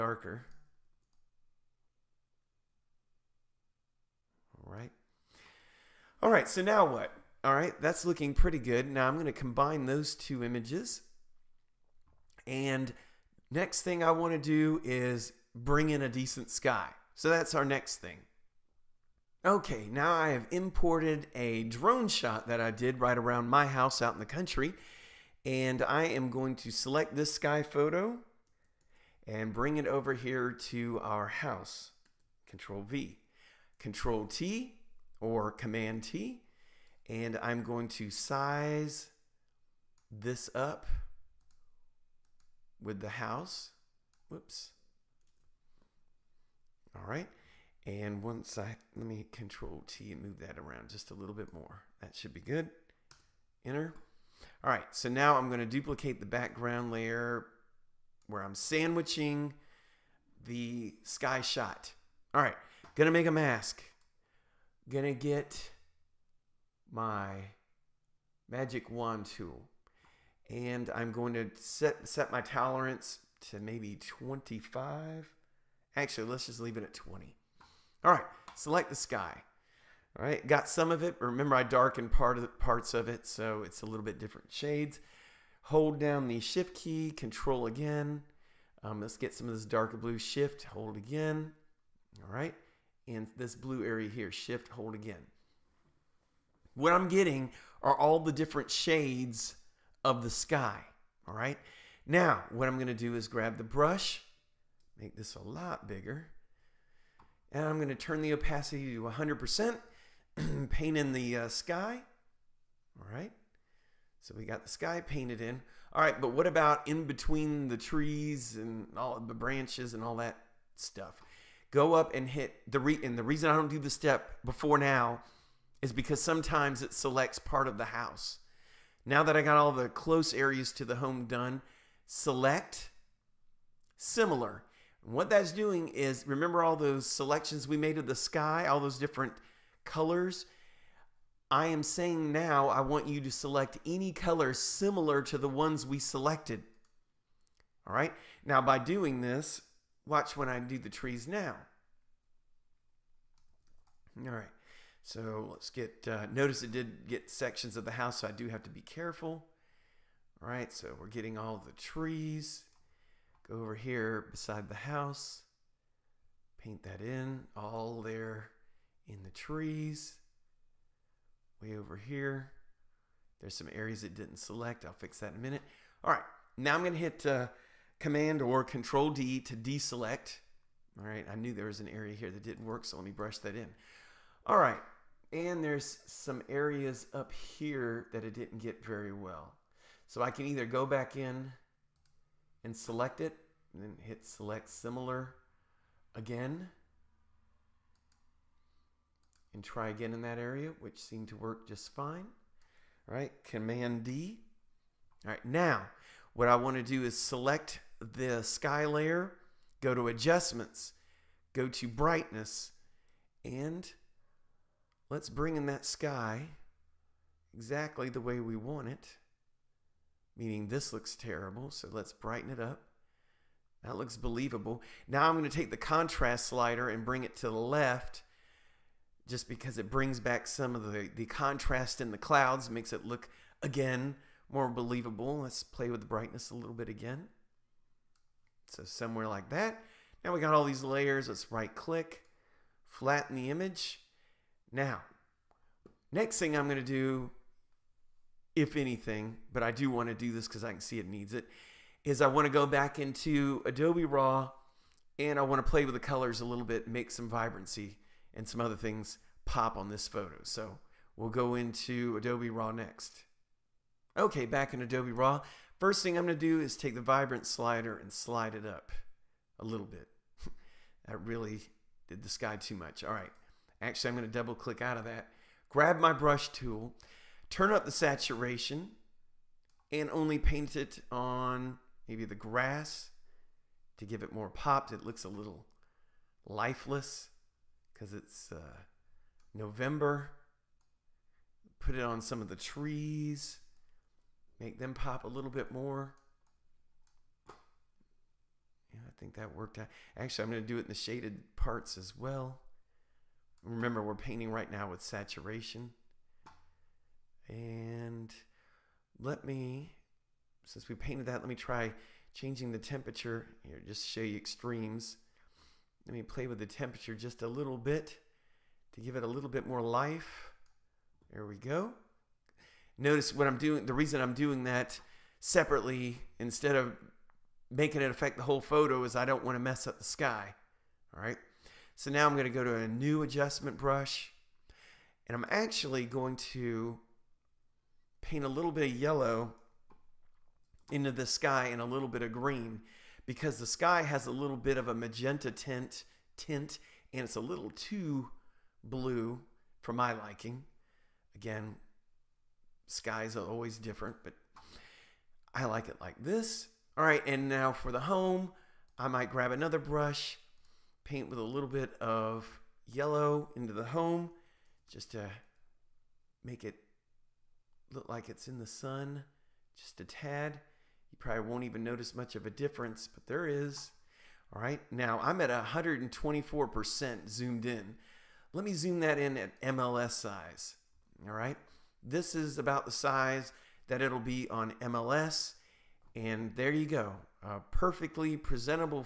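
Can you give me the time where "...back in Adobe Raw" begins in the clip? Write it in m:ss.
4:24.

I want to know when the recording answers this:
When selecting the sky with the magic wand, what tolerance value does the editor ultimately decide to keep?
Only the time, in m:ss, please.
1:16.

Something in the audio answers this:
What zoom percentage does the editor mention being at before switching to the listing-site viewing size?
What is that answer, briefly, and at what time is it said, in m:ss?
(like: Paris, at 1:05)
124%, at 6:15.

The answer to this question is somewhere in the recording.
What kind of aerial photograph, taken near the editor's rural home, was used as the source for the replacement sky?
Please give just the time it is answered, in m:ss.
0:21.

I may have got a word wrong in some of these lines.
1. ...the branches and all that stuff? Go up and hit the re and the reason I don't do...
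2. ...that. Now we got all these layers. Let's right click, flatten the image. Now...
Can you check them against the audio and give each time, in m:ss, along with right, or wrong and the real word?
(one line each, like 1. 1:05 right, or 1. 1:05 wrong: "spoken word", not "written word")
1. 1:59 right
2. 3:59 right.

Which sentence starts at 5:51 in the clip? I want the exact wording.
Again, skies are always different, but I like it like this.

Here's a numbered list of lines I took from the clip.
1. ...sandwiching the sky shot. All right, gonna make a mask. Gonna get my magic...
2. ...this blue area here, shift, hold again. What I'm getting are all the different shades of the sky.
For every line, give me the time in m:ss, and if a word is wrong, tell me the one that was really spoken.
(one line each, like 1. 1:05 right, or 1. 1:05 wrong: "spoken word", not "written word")
1. 0:58 right
2. 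1:33 right.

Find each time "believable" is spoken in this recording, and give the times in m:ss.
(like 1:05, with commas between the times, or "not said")
3:44, 3:54.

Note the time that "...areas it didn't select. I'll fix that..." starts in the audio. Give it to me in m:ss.
2:53.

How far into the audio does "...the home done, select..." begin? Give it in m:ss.
2:10.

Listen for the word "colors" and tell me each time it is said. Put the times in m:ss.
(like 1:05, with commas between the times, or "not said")
2:19, 2:24, 4:15.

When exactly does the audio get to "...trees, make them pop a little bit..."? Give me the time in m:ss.
4:52.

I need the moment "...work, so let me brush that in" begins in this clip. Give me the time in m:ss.
3:02.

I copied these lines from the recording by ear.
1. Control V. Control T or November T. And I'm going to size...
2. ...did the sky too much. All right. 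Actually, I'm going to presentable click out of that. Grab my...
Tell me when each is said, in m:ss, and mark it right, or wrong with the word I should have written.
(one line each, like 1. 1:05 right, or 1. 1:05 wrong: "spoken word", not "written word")
1. 0:32 wrong: "Command", not "November"
2. 4:32 wrong: "double", not "presentable".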